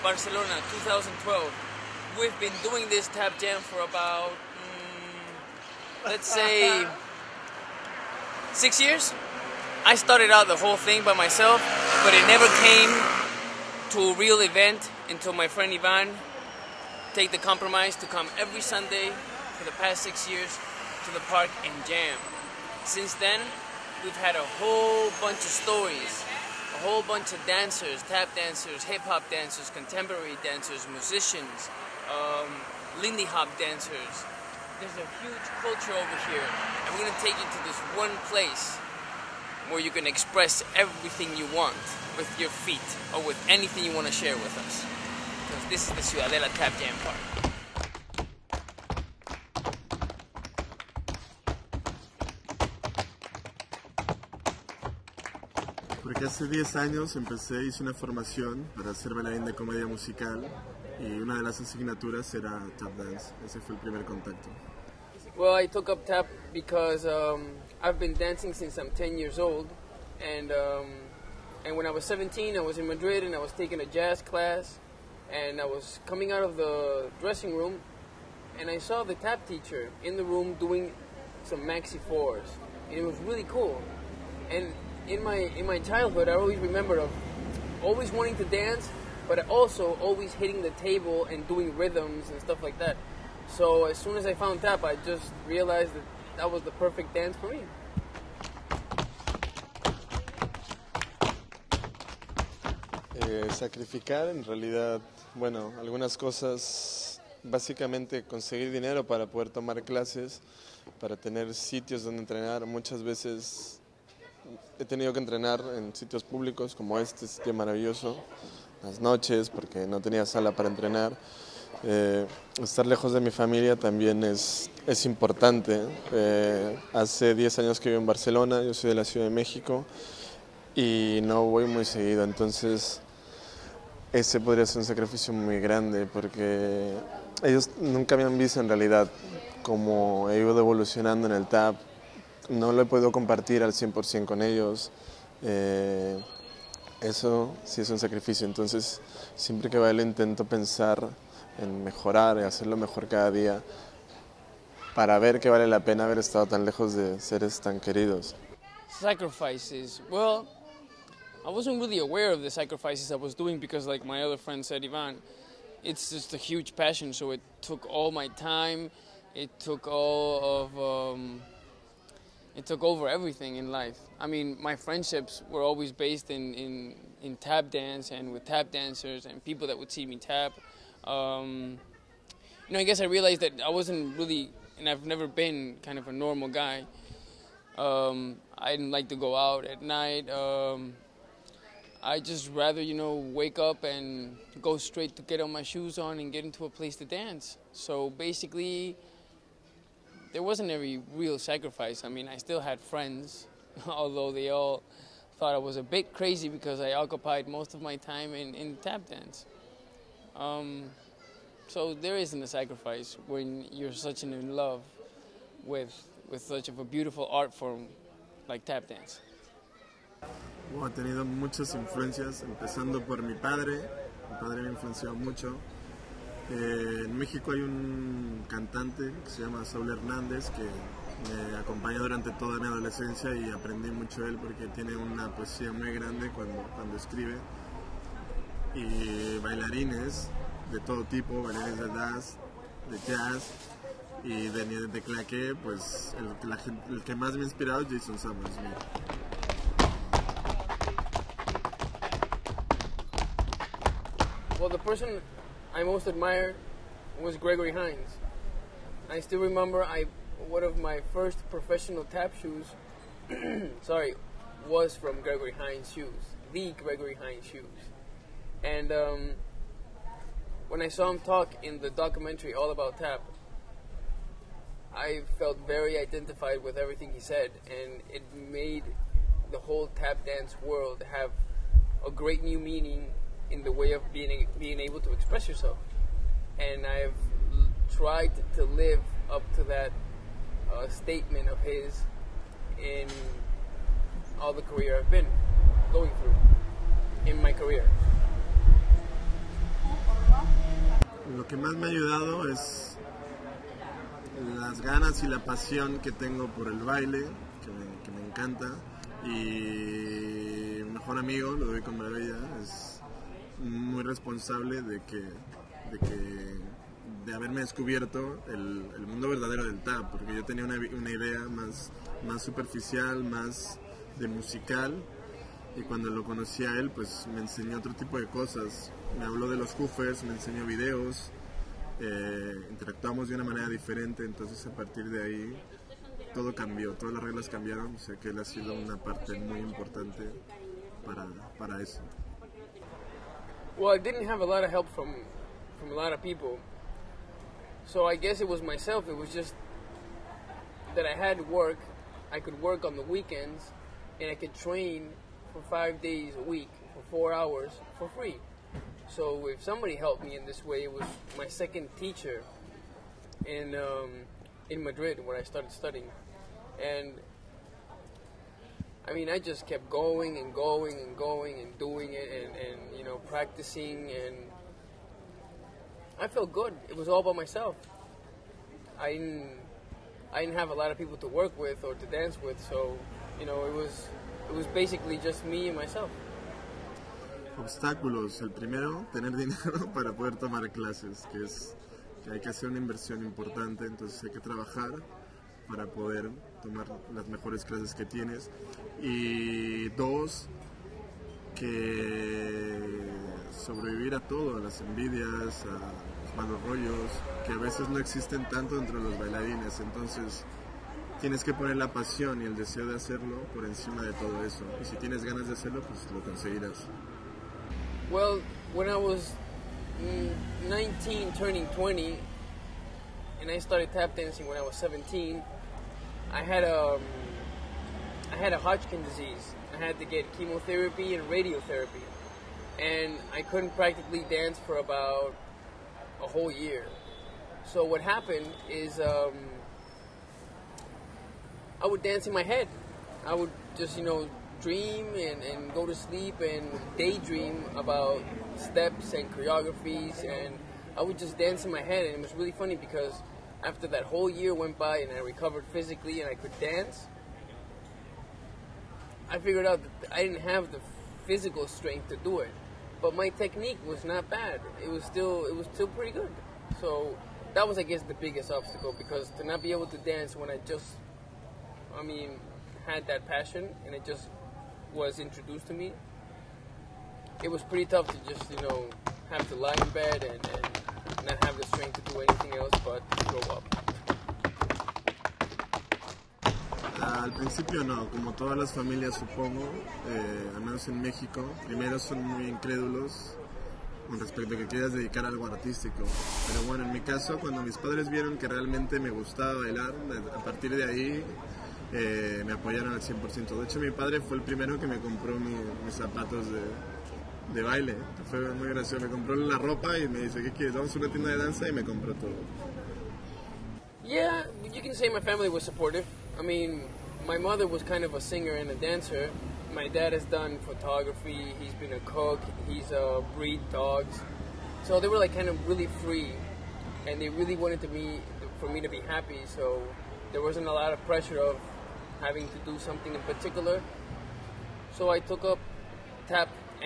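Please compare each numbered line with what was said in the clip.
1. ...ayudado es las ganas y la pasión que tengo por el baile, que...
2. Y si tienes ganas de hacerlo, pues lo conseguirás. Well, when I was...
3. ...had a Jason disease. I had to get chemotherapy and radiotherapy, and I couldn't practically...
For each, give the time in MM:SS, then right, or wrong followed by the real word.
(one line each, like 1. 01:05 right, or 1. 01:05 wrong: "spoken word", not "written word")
1. 05:01 right
2. 06:54 right
3. 07:08 wrong: "Hodgkin", not "Jason".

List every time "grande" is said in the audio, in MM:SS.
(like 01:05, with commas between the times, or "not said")
02:15, 03:55.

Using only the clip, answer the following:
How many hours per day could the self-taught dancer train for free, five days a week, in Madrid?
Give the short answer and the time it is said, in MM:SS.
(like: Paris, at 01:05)
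4, at 05:57.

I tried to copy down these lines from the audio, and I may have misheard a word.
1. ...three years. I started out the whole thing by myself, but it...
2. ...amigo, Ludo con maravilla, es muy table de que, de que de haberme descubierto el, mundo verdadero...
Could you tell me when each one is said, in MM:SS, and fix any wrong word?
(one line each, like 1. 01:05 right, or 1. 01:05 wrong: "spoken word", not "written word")
1. 00:08 wrong: "six", not "three"
2. 05:11 wrong: "responsable", not "table".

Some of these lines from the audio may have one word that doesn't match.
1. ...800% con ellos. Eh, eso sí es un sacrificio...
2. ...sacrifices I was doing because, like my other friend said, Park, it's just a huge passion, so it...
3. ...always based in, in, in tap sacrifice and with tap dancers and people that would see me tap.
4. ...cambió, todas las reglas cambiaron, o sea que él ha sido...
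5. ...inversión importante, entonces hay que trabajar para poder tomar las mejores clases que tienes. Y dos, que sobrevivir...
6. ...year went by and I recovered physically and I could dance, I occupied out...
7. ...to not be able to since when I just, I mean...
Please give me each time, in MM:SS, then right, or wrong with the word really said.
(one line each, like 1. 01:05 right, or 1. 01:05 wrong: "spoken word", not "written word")
1. 02:23 wrong: "100", not "800"
2. 02:42 wrong: "Ivan", not "Park"
3. 02:55 wrong: "dance", not "sacrifice"
4. 05:36 right
5. 06:32 right
6. 07:34 wrong: "figured", not "occupied"
7. 07:49 wrong: "dance", not "since".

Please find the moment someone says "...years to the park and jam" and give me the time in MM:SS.
00:20.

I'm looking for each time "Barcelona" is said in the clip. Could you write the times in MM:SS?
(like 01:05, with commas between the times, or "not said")
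00:00, 02:08.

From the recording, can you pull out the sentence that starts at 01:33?
So as soon as I found tap, I just realized that that was the perfect dance for me.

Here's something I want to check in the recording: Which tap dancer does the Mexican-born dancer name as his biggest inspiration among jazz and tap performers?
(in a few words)
Jason Samuels.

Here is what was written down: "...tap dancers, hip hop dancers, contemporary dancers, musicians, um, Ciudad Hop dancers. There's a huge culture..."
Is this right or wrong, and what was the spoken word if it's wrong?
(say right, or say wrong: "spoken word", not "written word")
wrong: "Lindy", not "Ciudad".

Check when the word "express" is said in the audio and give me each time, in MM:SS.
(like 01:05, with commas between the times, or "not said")
00:40, 04:45.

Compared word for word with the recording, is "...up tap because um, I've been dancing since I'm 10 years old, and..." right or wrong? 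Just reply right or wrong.
right.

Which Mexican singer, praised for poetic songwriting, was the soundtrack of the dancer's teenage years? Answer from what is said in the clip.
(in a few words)
Saul Hernández.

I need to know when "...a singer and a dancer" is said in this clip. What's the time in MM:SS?
08:38.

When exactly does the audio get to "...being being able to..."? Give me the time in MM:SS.
04:44.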